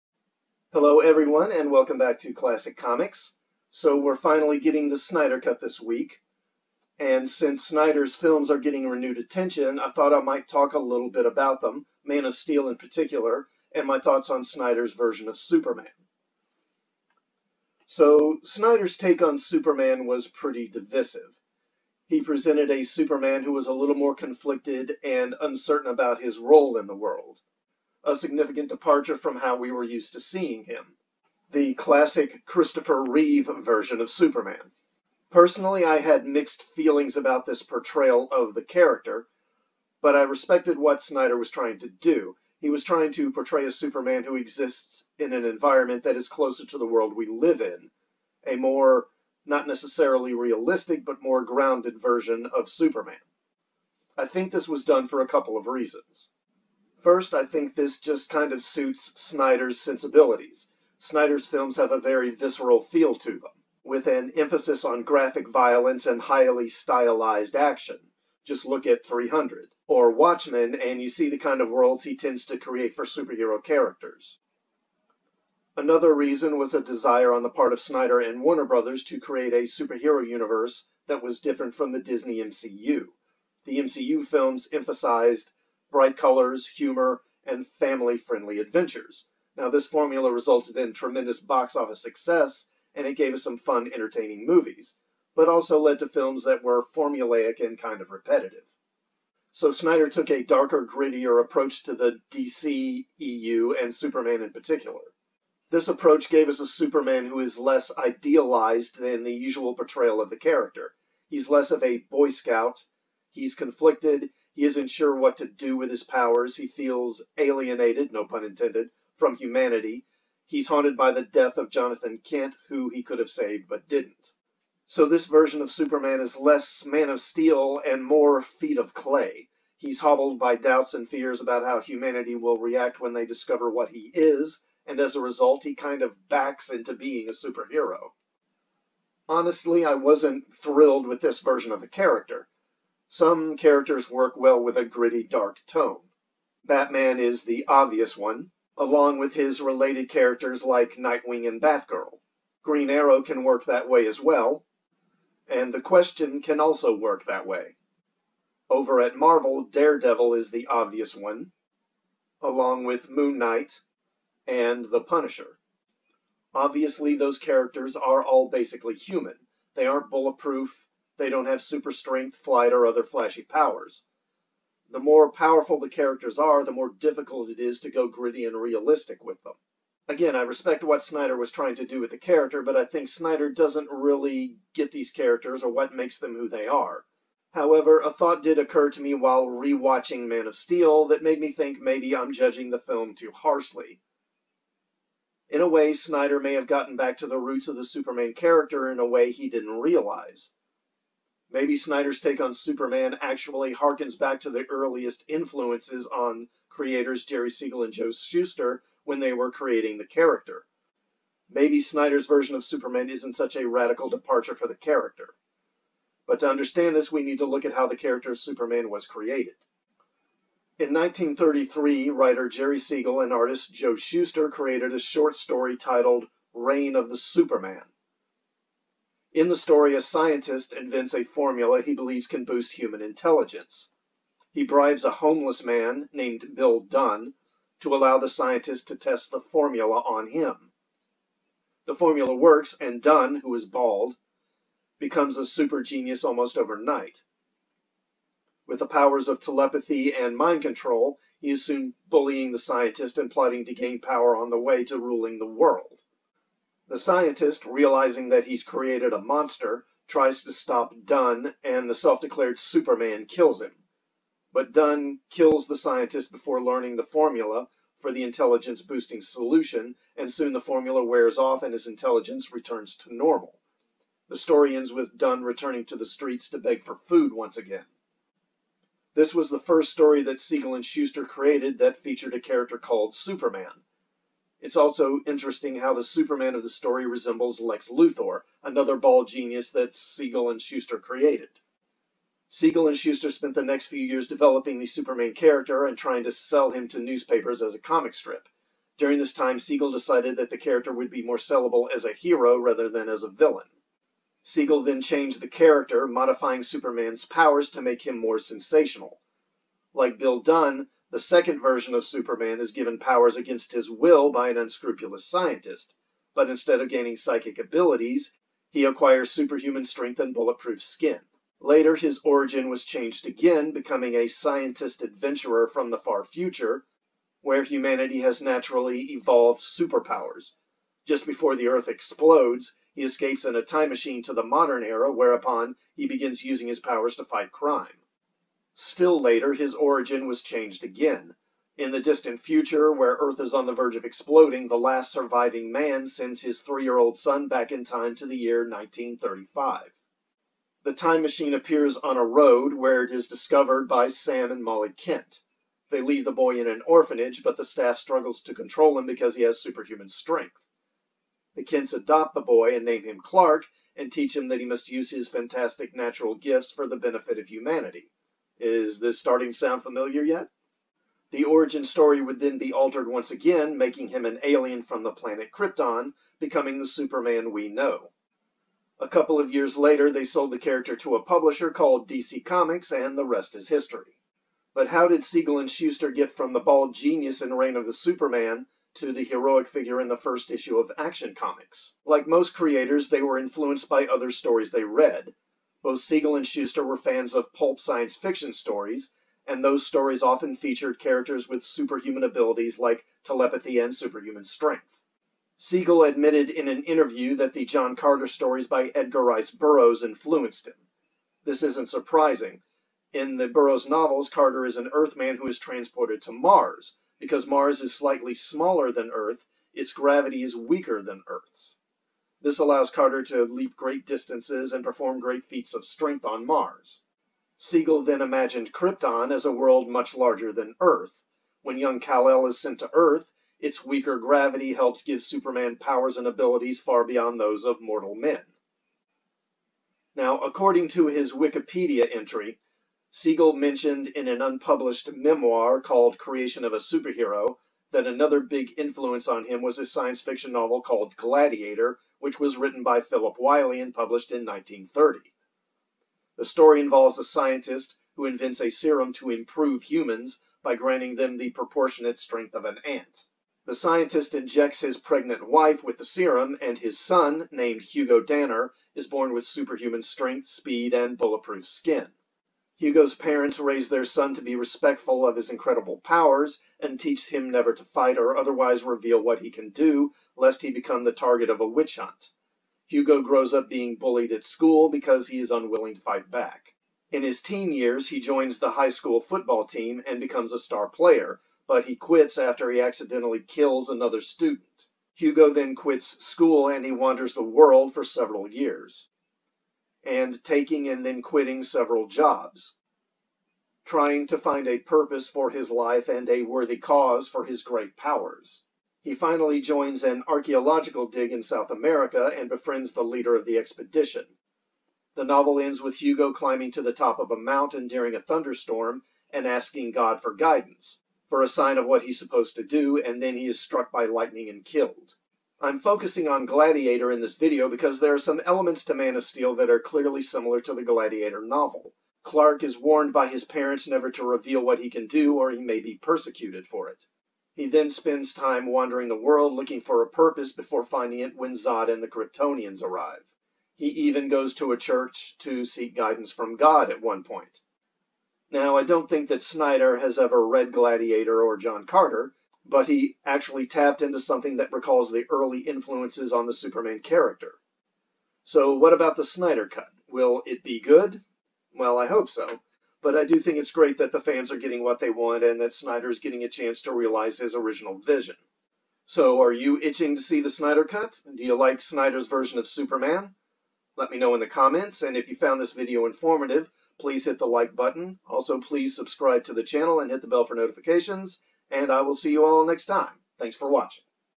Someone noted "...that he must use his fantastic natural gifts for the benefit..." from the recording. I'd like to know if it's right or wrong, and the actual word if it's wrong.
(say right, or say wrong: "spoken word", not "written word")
right.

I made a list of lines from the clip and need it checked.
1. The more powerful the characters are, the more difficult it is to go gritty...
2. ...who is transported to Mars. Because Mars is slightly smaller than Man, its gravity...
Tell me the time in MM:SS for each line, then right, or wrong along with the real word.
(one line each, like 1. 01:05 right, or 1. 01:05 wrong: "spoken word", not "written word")
1. 02:54 right
2. 06:55 wrong: "Earth", not "Man".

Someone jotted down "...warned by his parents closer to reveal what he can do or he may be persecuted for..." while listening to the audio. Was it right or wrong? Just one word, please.
wrong.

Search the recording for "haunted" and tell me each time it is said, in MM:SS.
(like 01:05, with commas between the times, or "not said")
02:00.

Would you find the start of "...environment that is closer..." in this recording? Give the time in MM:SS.
00:45.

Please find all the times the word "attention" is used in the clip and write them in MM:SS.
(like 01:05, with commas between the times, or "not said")
00:09.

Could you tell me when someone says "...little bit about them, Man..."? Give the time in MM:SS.
00:10.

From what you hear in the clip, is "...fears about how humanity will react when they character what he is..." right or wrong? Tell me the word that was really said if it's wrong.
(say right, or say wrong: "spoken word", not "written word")
wrong: "discover", not "character".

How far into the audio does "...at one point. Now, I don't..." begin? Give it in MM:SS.
09:06.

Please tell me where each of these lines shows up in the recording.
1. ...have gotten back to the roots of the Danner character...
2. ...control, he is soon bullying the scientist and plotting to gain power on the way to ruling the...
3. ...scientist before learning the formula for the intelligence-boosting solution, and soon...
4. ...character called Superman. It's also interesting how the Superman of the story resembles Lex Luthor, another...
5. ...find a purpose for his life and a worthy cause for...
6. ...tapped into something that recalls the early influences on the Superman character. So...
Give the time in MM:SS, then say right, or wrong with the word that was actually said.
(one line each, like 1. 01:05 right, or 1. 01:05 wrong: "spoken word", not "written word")
1. 03:16 wrong: "Superman", not "Danner"
2. 04:10 right
3. 04:25 right
4. 04:42 right
5. 08:24 right
6. 09:13 right.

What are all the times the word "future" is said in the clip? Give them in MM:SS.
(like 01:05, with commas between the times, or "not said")
05:26, 05:42.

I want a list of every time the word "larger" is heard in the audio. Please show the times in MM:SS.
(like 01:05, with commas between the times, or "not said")
07:10.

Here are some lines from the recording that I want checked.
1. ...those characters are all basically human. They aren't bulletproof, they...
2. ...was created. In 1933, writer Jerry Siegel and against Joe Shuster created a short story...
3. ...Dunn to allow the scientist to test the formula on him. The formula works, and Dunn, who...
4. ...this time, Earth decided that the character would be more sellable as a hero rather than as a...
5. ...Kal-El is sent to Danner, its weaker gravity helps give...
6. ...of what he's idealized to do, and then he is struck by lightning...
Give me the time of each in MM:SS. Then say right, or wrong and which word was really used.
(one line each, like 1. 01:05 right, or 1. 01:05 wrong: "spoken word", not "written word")
1. 02:47 right
2. 03:38 wrong: "artist", not "against"
3. 03:56 right
4. 04:59 wrong: "Siegel", not "Earth"
5. 07:11 wrong: "Earth", not "Danner"
6. 08:41 wrong: "supposed", not "idealized".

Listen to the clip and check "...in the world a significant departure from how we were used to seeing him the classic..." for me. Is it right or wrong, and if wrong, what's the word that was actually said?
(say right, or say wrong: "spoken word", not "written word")
right.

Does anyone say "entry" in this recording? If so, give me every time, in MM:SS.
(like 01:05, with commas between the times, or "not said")
07:22.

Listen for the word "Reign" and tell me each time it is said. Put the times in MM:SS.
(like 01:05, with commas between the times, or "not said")
03:46, 06:27.